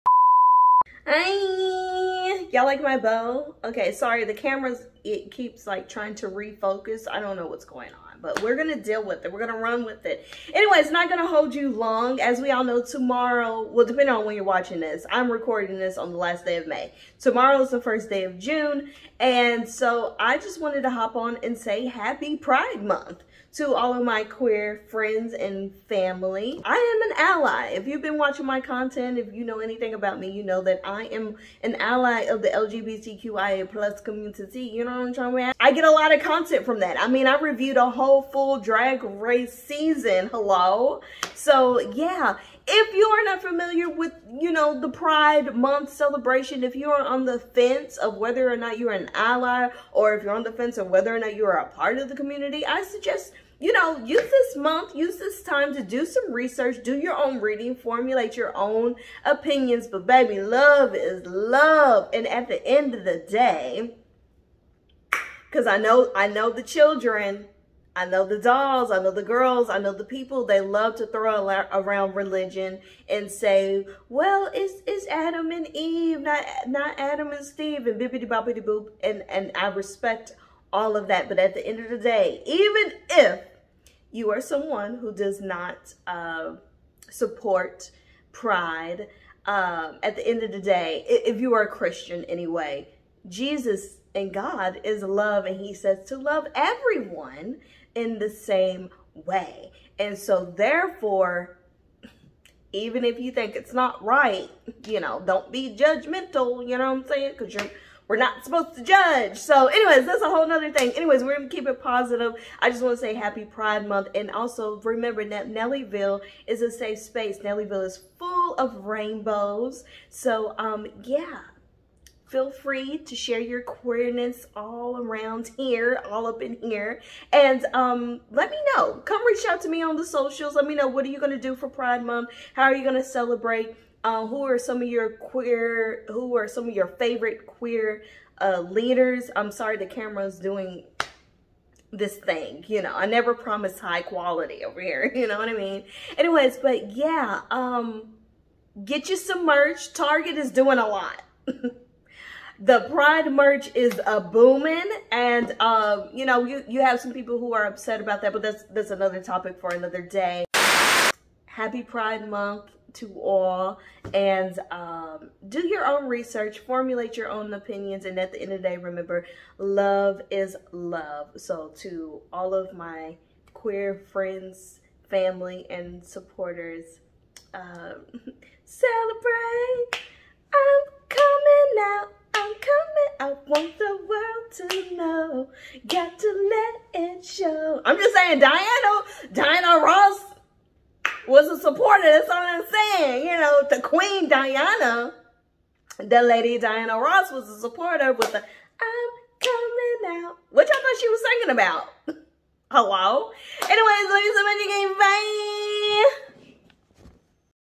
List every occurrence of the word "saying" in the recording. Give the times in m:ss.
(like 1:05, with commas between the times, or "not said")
1:47, 3:08, 3:12.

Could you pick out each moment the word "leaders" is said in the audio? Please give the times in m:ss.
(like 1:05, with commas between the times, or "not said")
2:18.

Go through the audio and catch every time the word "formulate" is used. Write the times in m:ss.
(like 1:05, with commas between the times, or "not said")
0:57, 2:46.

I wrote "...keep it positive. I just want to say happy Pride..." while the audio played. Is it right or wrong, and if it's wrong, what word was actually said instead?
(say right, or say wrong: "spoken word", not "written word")
right.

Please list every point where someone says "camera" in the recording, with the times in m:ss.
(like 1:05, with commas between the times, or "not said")
0:04, 2:19.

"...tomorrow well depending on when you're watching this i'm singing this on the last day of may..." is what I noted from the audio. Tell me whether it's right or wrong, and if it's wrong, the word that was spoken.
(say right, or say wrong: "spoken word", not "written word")
wrong: "recording", not "singing".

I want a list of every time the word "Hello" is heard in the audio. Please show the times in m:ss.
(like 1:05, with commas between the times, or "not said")
0:40, 3:22.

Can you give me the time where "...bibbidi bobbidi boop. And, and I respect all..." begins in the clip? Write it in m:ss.
1:17.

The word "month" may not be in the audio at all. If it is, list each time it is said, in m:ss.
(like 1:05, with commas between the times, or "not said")
0:22, 0:45, 0:54, 1:53, 2:12, 2:42.